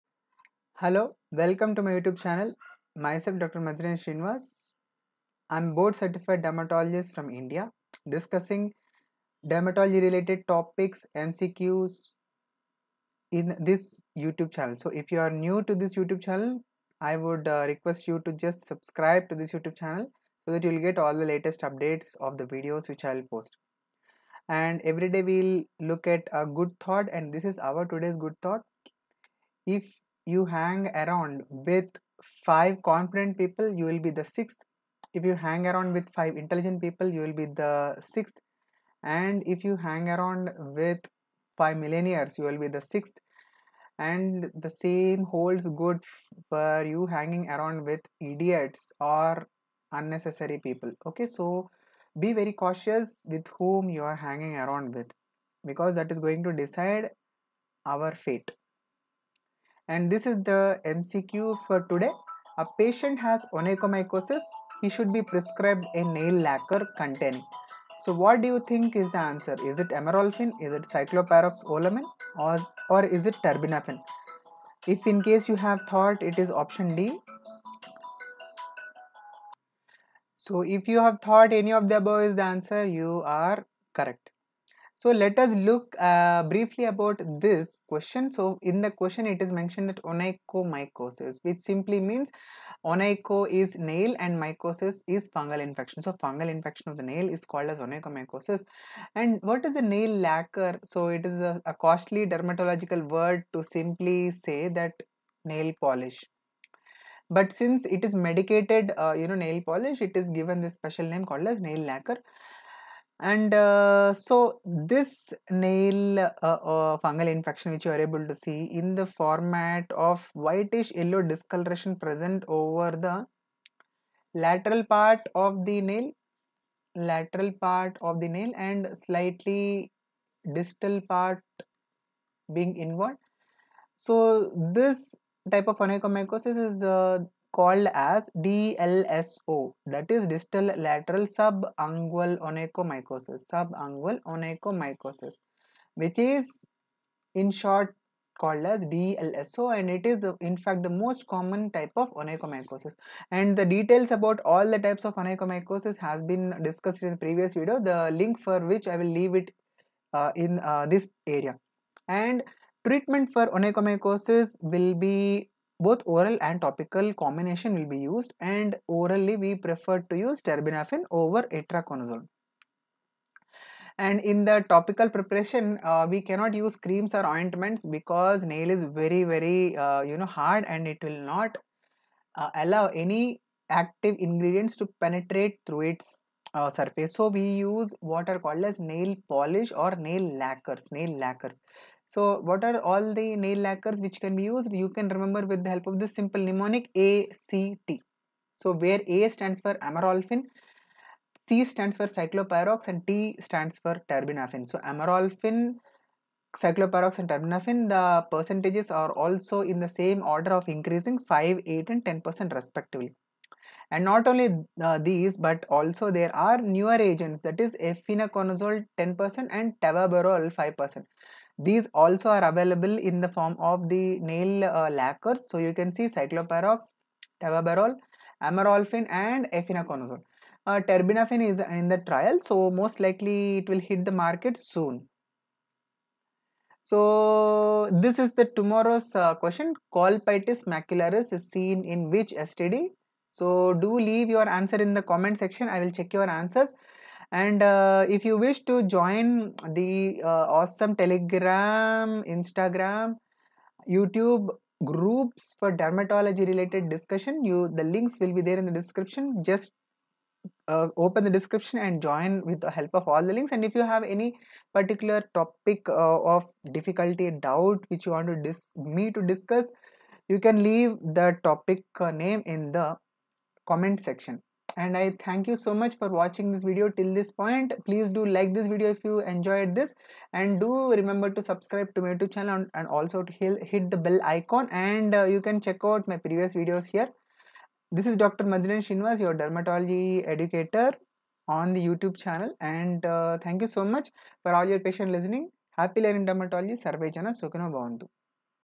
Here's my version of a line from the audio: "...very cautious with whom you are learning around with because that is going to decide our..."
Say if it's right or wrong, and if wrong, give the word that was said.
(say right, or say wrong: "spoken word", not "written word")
wrong: "hanging", not "learning".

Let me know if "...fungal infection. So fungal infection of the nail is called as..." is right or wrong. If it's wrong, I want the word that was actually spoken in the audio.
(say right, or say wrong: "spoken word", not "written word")
right.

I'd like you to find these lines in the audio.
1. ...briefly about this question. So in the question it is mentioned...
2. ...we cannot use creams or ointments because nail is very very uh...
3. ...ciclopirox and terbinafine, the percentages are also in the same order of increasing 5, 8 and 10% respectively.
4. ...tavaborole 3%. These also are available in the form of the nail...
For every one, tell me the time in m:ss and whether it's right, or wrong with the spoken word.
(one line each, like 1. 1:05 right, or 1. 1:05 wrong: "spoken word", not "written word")
1. 1:26 right
2. 2:56 right
3. 3:26 right
4. 3:39 wrong: "5", not "3".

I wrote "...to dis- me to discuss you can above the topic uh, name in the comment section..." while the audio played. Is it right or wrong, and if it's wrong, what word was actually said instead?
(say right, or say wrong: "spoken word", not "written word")
wrong: "leave", not "above".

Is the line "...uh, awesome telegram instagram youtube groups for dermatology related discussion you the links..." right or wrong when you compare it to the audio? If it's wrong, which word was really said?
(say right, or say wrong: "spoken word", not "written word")
right.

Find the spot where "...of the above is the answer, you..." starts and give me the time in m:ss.
1:21.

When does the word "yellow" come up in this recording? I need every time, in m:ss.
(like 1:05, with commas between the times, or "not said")
2:00.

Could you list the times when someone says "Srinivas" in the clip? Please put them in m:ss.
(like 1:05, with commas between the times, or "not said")
0:04, 4:48.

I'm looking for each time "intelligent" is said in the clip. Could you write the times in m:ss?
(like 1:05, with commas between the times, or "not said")
0:36.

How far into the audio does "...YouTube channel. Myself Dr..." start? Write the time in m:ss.
0:01.